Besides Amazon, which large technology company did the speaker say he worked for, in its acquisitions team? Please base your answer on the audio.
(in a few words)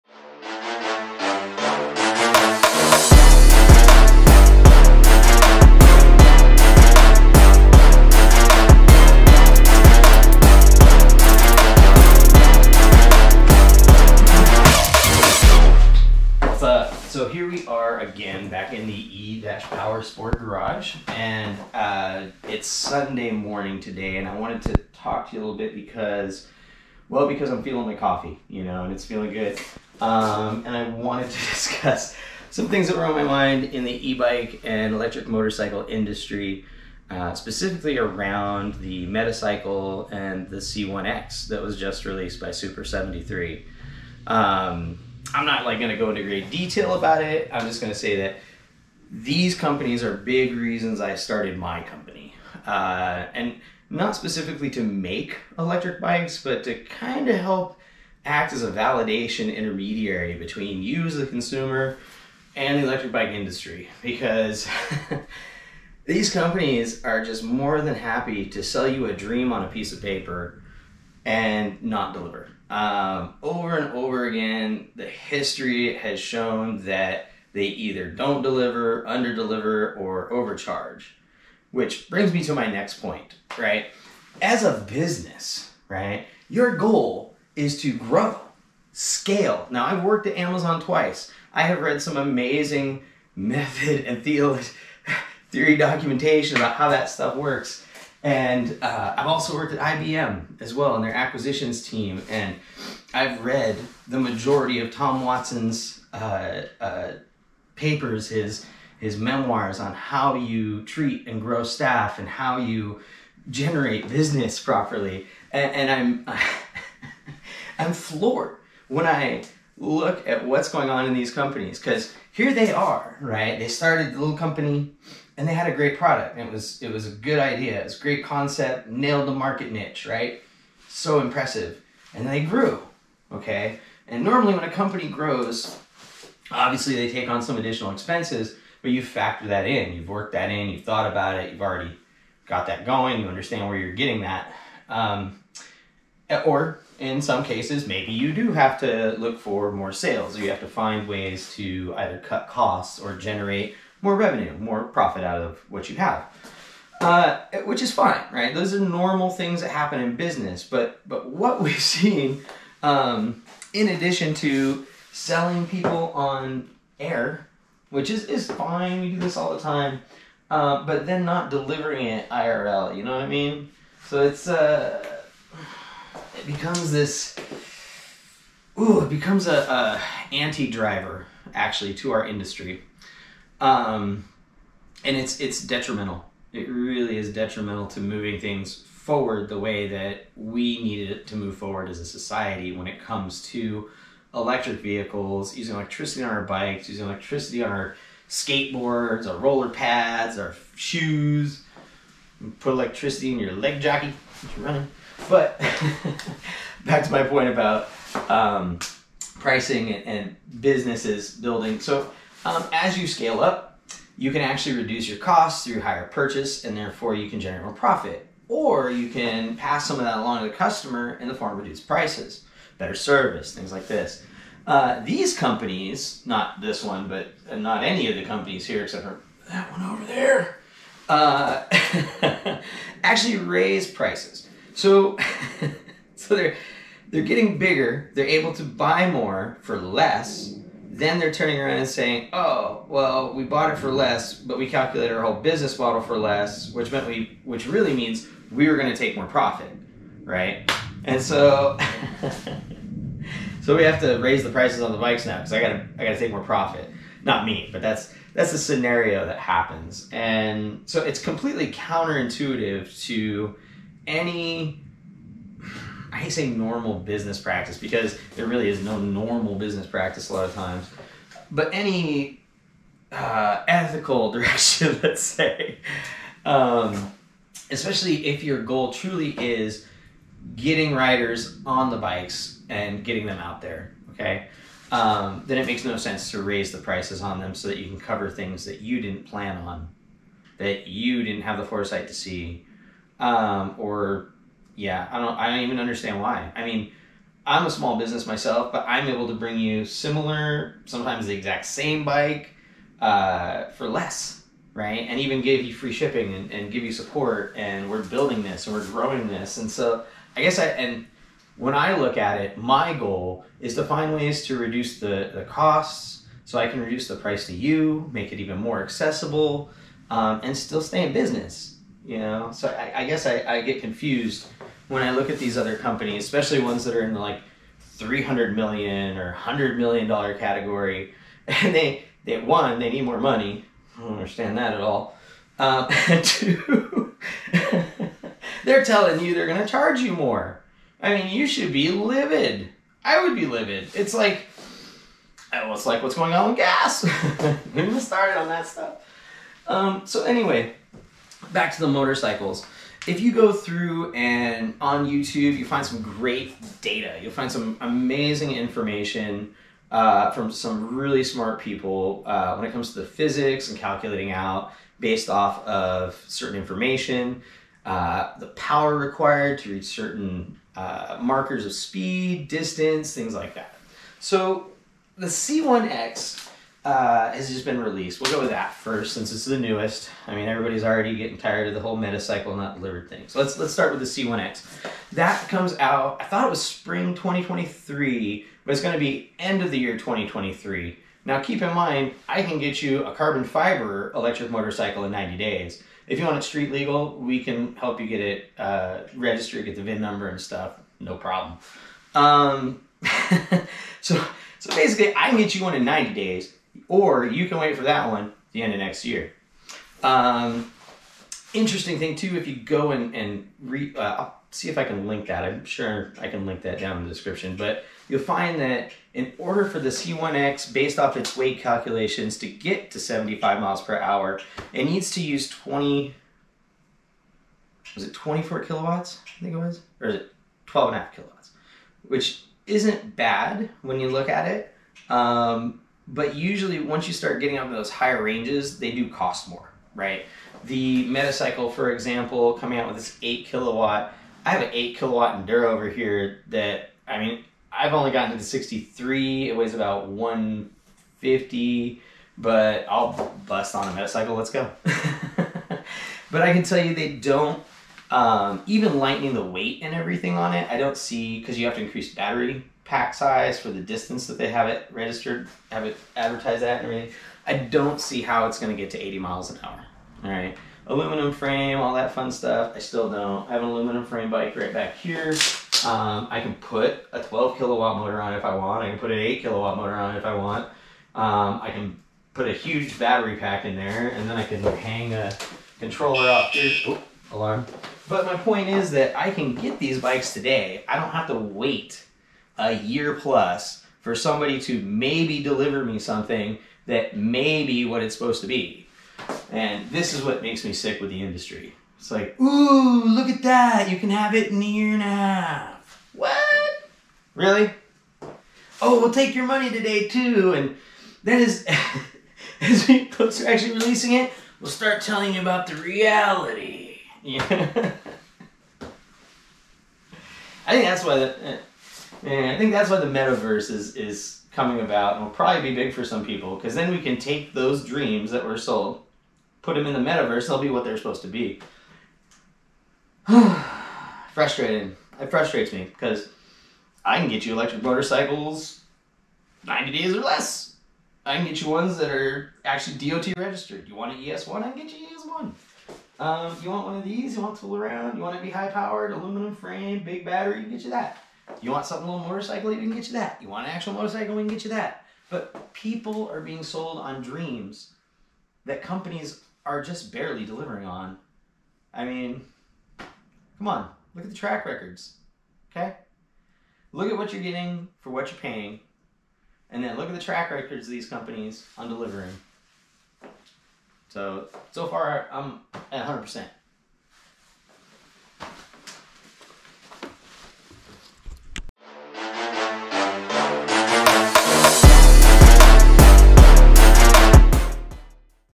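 IBM.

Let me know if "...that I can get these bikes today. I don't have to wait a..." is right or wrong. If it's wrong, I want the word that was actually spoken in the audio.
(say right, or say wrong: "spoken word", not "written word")
right.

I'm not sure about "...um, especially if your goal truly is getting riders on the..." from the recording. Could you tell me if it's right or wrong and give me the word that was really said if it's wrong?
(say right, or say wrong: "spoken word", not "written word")
right.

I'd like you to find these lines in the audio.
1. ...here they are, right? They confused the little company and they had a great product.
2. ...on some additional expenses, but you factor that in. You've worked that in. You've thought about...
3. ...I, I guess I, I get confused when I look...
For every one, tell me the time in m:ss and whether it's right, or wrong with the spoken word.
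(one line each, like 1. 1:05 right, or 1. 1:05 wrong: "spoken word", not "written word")
1. 2:02 wrong: "started", not "confused"
2. 2:17 right
3. 5:22 right.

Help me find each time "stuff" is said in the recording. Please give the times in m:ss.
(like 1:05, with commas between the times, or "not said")
1:37, 5:48, 6:40, 7:52.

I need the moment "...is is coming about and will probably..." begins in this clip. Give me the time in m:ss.
8:43.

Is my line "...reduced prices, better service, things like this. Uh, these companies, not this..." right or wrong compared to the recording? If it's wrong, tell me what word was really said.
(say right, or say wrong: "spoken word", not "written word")
right.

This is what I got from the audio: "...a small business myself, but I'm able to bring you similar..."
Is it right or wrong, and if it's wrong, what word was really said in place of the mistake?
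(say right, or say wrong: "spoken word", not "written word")
right.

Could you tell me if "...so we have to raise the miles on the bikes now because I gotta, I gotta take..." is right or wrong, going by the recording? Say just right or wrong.
wrong.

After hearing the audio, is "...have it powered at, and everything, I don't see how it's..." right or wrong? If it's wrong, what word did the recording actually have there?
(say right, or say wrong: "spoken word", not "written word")
wrong: "advertised", not "powered".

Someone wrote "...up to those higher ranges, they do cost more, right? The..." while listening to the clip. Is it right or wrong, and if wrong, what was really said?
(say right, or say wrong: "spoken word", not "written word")
right.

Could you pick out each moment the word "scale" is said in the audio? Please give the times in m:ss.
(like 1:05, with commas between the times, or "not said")
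1:28, 3:33.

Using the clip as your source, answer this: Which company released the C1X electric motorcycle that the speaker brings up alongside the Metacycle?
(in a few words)
Super73.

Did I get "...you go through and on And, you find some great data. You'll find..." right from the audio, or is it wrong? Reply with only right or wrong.
wrong.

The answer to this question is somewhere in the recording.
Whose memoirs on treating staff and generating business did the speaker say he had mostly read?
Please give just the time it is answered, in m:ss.
1:44.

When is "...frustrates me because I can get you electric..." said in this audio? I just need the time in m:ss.
8:55.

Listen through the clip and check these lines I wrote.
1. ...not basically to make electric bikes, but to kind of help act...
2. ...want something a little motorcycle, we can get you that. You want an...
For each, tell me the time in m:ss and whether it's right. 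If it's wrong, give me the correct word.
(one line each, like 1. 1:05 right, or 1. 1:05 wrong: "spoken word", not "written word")
1. 0:53 wrong: "specifically", not "basically"
2. 9:11 right.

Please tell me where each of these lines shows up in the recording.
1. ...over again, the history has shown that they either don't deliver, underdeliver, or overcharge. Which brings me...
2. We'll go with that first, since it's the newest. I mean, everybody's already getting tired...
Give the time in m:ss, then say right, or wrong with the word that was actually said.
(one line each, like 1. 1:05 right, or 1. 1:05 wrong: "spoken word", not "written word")
1. 1:13 right
2. 6:18 right.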